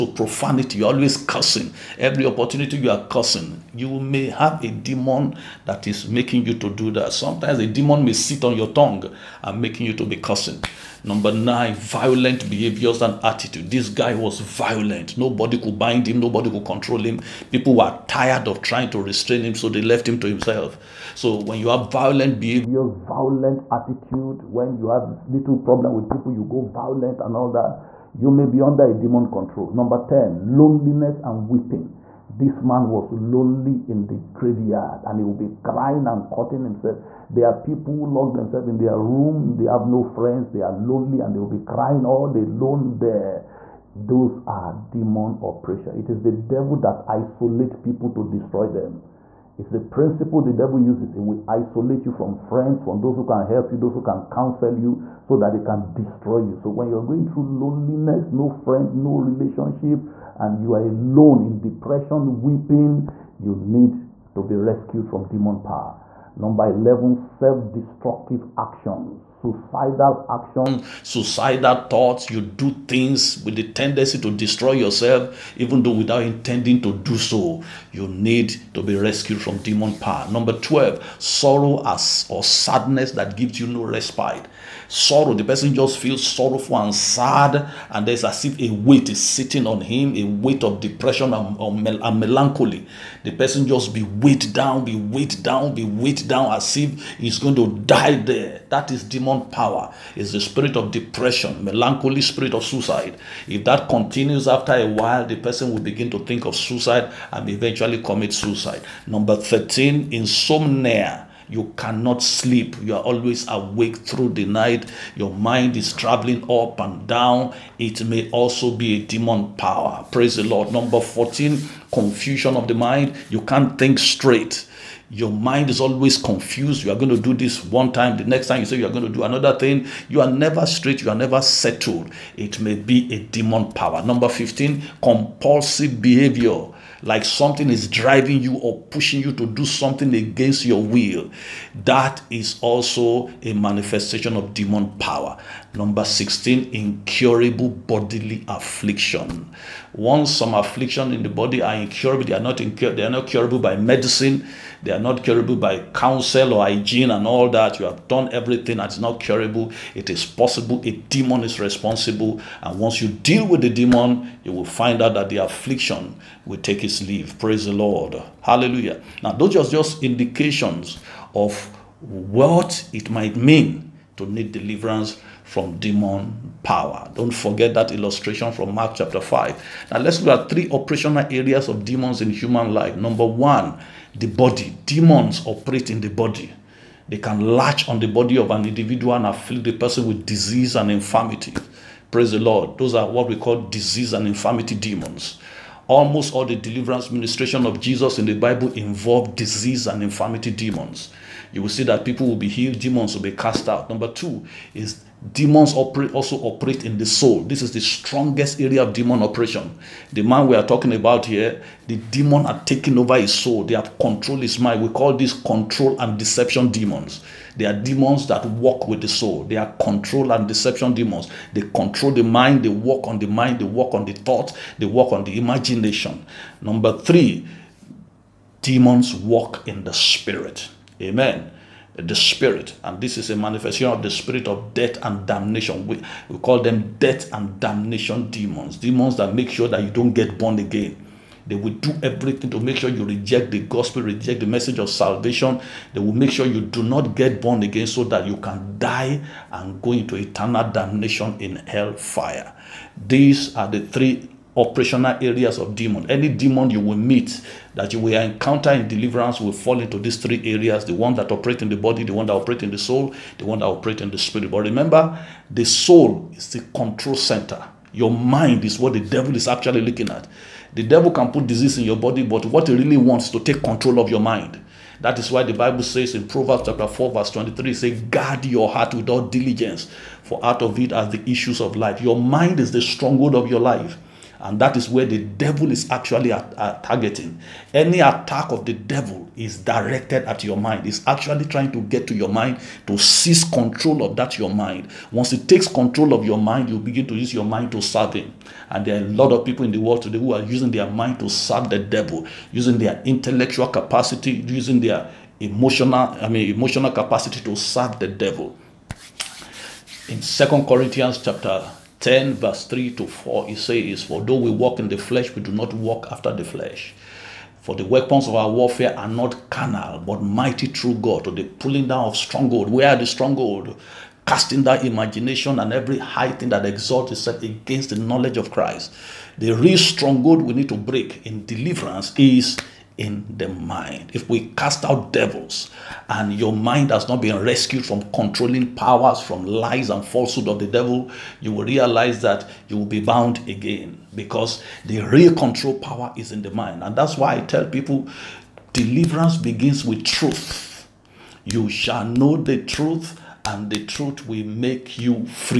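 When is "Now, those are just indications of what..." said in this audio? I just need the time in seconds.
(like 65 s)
169 s.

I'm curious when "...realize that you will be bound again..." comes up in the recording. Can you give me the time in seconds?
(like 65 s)
341 s.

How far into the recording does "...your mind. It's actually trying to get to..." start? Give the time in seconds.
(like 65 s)
290 s.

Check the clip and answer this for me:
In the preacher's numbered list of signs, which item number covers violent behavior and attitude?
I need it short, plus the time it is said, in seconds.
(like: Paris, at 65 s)
9, at 11 s.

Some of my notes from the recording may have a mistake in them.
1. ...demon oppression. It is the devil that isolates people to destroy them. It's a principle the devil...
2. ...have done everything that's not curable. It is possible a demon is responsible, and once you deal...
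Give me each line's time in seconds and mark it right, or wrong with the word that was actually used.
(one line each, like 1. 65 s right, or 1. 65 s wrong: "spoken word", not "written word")
1. 44 s right
2. 157 s right.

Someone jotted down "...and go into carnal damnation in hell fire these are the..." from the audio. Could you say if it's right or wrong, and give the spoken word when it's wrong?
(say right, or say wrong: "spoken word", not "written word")
wrong: "eternal", not "carnal".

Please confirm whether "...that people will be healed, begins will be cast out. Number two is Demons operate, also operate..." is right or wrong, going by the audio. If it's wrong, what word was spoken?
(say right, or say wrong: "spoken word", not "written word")
wrong: "demons", not "begins".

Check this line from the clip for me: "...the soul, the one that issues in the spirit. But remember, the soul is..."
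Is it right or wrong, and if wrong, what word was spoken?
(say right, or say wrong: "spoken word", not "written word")
wrong: "operates", not "issues".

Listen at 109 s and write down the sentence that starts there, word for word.
Number 13, insomnia you cannot sleep.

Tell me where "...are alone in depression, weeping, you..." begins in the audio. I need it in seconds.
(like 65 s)
60 s.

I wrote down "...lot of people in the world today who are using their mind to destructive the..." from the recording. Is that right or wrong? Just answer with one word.
wrong.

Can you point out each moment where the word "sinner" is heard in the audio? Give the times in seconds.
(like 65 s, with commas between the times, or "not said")
not said.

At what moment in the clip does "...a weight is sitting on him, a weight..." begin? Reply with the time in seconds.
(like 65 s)
88 s.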